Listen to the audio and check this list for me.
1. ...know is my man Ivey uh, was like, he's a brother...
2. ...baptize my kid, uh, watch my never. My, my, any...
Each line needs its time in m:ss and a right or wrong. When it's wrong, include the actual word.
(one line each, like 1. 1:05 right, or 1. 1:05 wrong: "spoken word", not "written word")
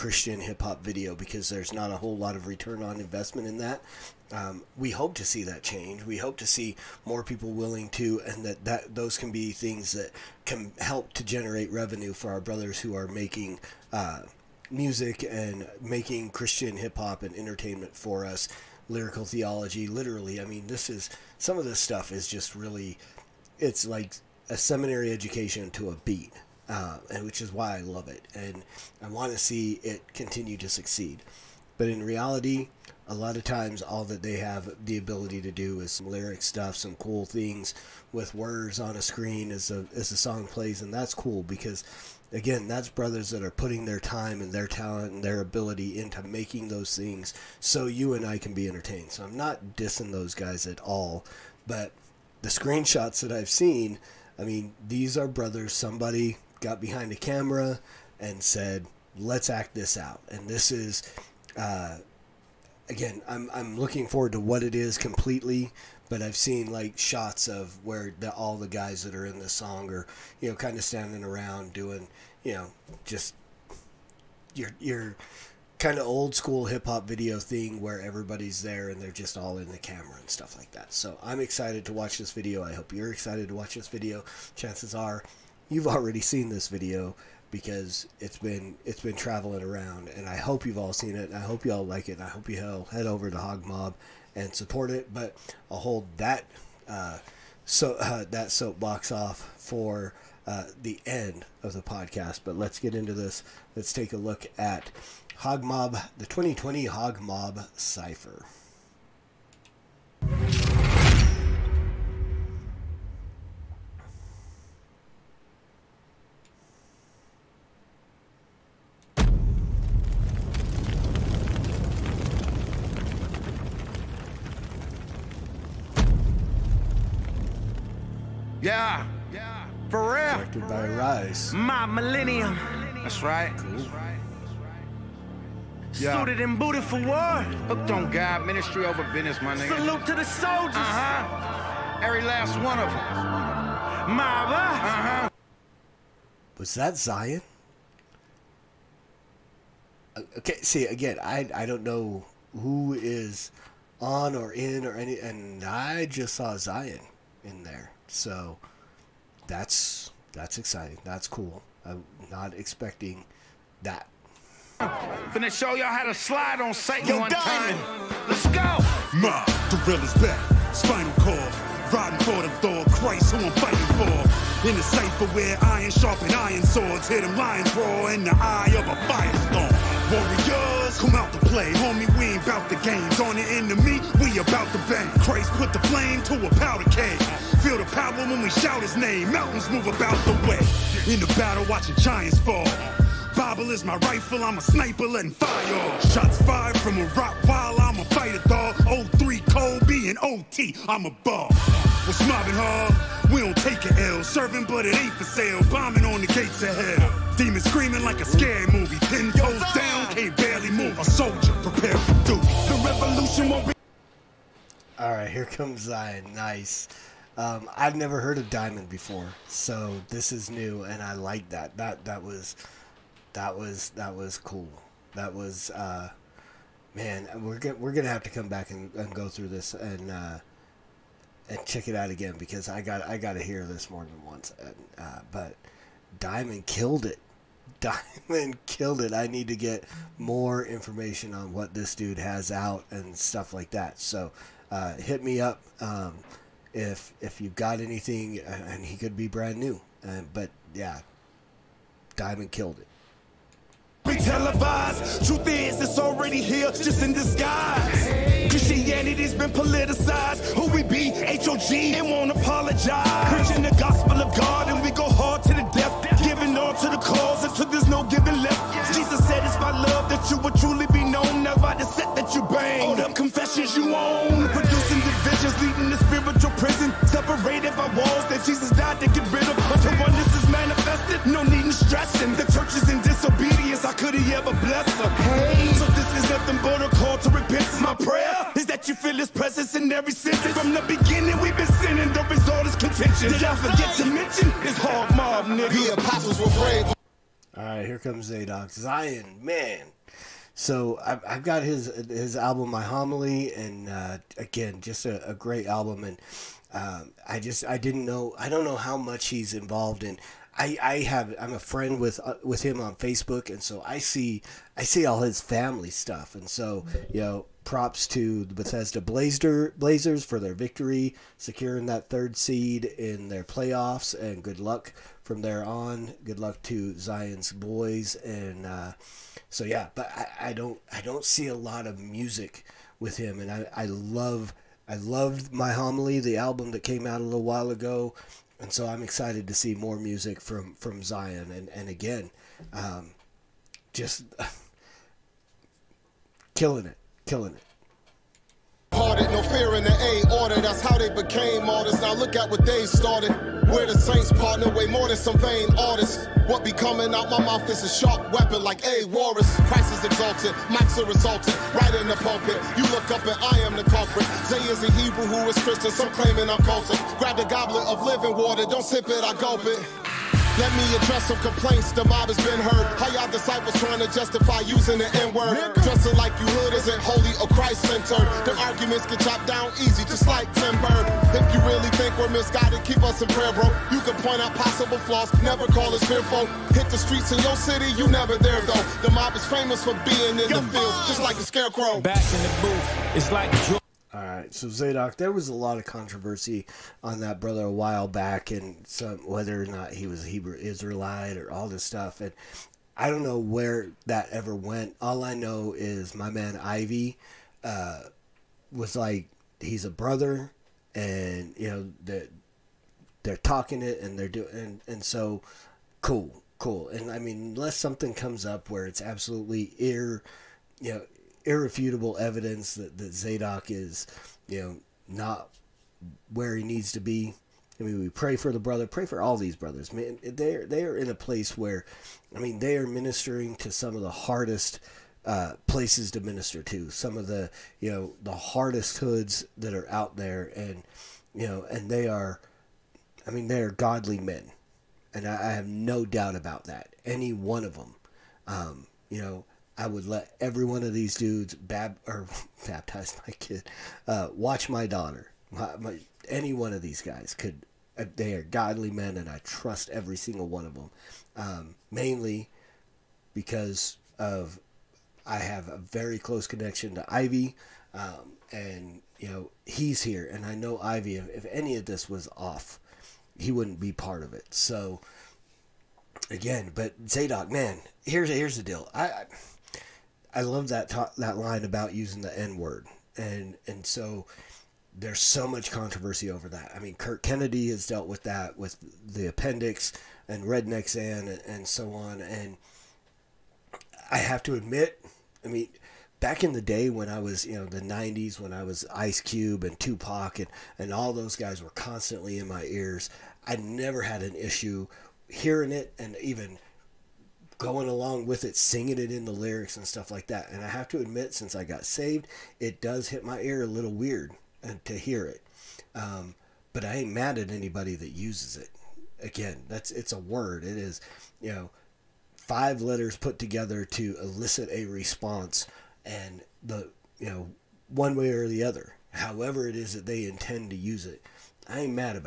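1. 6:45 right
2. 7:32 wrong: "daughter", not "never".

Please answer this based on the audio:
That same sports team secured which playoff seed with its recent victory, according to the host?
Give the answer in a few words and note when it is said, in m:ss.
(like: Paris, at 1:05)
Third, at 5:22.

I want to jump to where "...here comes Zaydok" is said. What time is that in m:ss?
4:57.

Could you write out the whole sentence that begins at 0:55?
Somebody got behind a camera and said, let's act this out.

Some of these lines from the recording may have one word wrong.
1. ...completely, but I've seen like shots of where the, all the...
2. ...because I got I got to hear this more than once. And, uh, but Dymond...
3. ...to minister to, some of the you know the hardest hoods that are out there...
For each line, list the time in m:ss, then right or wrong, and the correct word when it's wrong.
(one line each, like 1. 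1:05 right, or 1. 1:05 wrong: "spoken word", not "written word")
1. 1:04 right
2. 3:52 right
3. 7:16 right.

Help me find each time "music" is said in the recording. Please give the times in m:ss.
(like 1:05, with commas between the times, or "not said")
0:14, 5:32, 5:39.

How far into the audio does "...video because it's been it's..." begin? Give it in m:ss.
1:26.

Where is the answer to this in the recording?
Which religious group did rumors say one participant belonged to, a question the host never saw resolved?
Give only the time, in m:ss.
6:40.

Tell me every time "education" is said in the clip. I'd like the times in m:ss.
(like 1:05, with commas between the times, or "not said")
0:25.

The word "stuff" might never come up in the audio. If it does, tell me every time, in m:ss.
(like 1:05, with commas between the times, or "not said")
0:21, 0:36, 1:20, 4:03, 5:15, 6:41, 8:29.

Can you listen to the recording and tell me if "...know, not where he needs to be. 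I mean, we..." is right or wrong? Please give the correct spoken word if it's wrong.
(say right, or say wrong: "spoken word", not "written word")
right.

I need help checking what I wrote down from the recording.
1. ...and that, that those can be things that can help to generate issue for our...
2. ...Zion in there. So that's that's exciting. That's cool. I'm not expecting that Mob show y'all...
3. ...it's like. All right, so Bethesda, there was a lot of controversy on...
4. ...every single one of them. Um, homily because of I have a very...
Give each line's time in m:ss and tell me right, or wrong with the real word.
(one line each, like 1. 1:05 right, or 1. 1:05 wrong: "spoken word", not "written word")
1. 0:08 wrong: "revenue", not "issue"
2. 2:36 wrong: "Finna", not "Mob"
3. 6:33 wrong: "Zaydok", not "Bethesda"
4. 7:39 wrong: "mainly", not "homily".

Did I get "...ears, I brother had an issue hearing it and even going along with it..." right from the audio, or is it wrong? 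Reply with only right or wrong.
wrong.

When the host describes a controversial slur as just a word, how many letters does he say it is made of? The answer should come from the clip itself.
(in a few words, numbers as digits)
5.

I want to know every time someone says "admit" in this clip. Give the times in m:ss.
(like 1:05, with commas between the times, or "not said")
8:14, 8:30.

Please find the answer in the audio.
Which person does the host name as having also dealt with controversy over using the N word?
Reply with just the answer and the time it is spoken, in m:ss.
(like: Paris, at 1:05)
Curt Kennedy, at 8:06.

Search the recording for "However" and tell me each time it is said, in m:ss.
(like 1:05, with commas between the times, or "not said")
8:49.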